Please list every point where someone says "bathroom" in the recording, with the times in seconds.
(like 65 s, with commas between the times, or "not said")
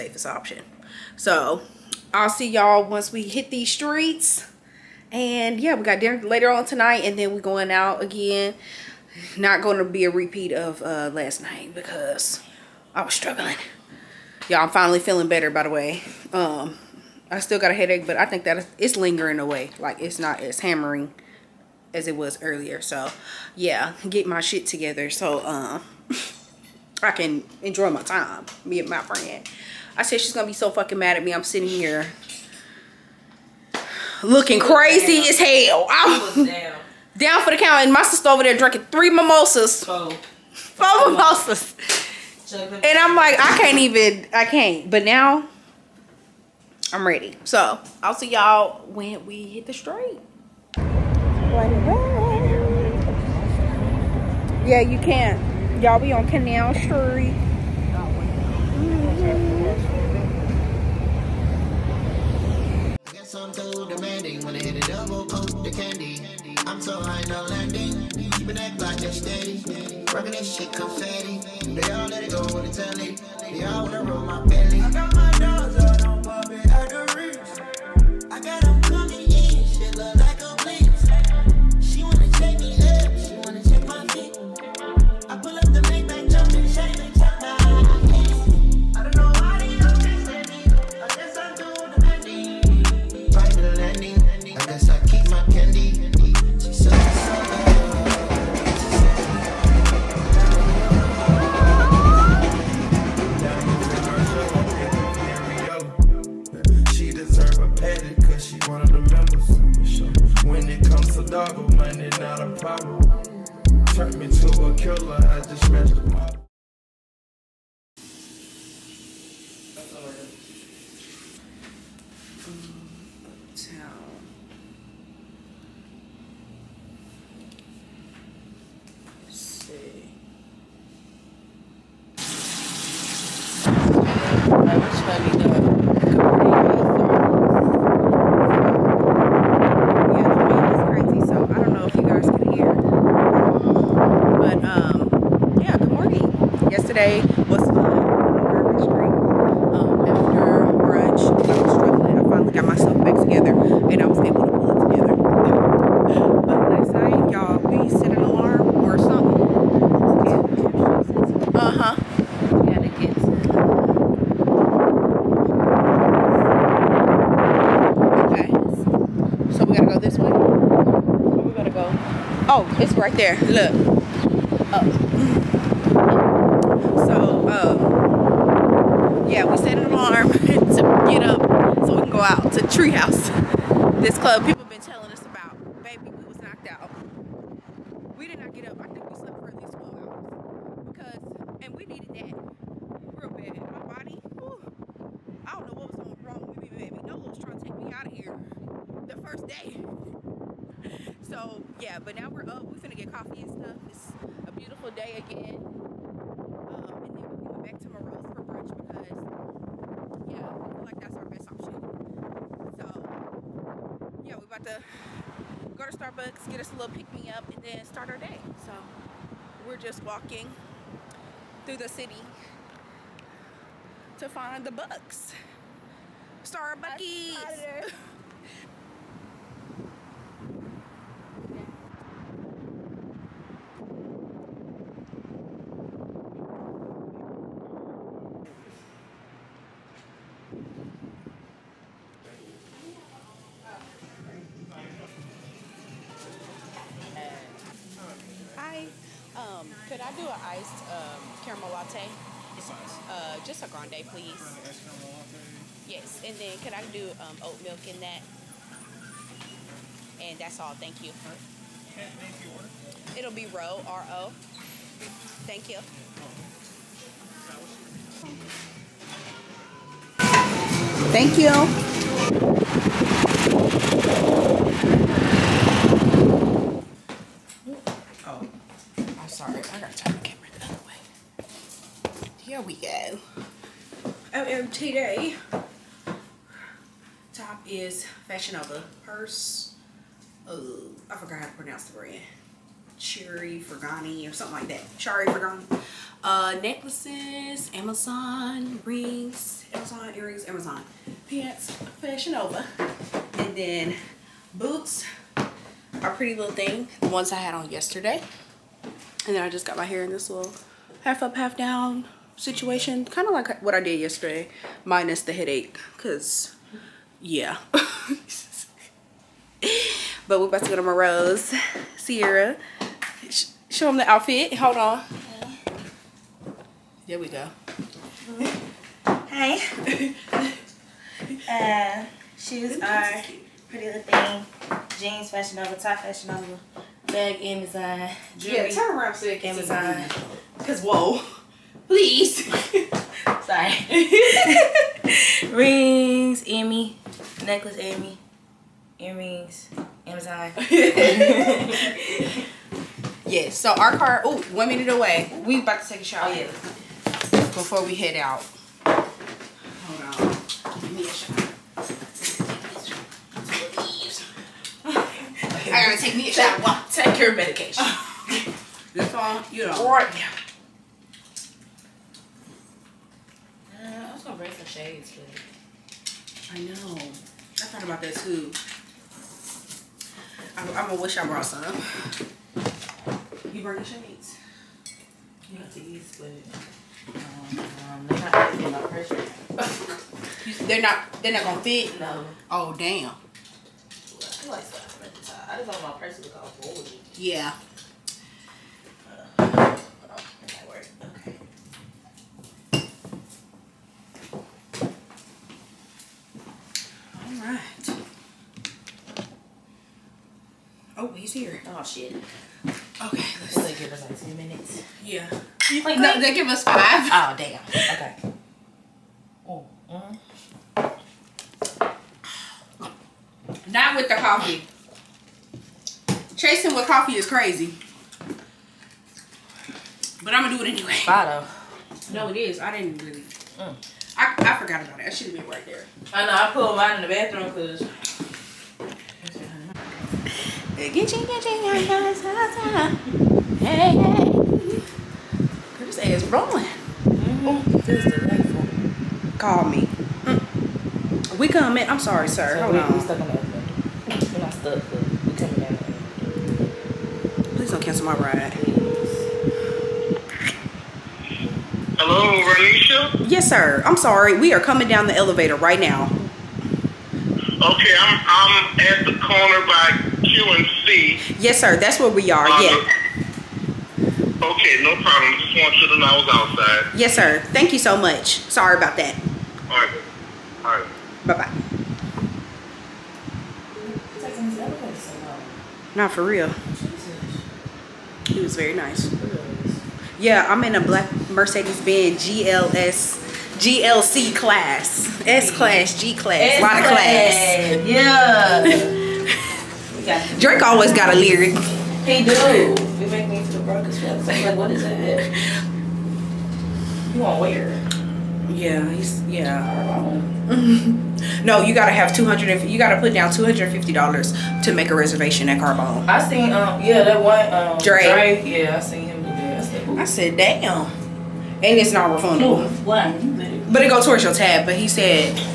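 437 s.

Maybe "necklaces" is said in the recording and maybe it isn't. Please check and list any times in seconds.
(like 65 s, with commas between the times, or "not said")
296 s, 347 s.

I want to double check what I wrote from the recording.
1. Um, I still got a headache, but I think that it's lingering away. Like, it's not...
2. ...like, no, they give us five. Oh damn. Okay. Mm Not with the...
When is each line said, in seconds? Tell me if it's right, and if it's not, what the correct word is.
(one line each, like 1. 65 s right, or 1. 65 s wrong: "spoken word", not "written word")
1. 16 s right
2. 415 s right.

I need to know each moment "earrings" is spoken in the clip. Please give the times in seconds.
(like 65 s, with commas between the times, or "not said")
300 s, 348 s.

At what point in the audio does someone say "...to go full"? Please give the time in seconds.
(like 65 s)
396 s.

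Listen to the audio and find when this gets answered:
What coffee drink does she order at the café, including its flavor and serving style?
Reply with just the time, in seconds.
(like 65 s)
250 s.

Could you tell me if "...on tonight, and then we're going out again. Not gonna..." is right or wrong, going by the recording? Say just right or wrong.
right.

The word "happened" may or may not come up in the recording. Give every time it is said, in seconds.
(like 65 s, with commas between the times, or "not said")
not said.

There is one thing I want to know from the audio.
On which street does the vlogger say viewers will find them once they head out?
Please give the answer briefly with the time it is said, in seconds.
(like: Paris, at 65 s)
Canal Street, at 56 s.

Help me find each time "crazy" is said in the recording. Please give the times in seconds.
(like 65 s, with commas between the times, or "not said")
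34 s, 427 s.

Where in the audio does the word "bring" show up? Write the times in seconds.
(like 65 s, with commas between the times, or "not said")
374 s, 383 s.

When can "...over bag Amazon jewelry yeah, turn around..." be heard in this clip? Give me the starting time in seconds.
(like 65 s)
336 s.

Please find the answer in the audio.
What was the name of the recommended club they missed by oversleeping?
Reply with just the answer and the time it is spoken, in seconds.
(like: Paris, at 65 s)
Treehouse, at 182 s.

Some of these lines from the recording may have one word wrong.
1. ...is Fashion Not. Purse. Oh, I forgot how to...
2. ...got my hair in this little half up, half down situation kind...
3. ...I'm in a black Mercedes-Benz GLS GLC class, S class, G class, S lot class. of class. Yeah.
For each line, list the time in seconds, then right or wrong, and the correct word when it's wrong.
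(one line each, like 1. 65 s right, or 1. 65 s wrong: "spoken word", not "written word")
1. 287 s wrong: "Nova", not "Not"
2. 309 s right
3. 490 s right.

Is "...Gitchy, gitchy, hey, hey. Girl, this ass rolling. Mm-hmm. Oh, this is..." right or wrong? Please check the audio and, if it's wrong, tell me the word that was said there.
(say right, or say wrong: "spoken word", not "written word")
right.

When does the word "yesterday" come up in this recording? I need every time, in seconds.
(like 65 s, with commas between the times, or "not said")
307 s, 313 s.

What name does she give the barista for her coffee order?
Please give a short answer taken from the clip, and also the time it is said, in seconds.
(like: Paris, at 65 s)
Ro, at 263 s.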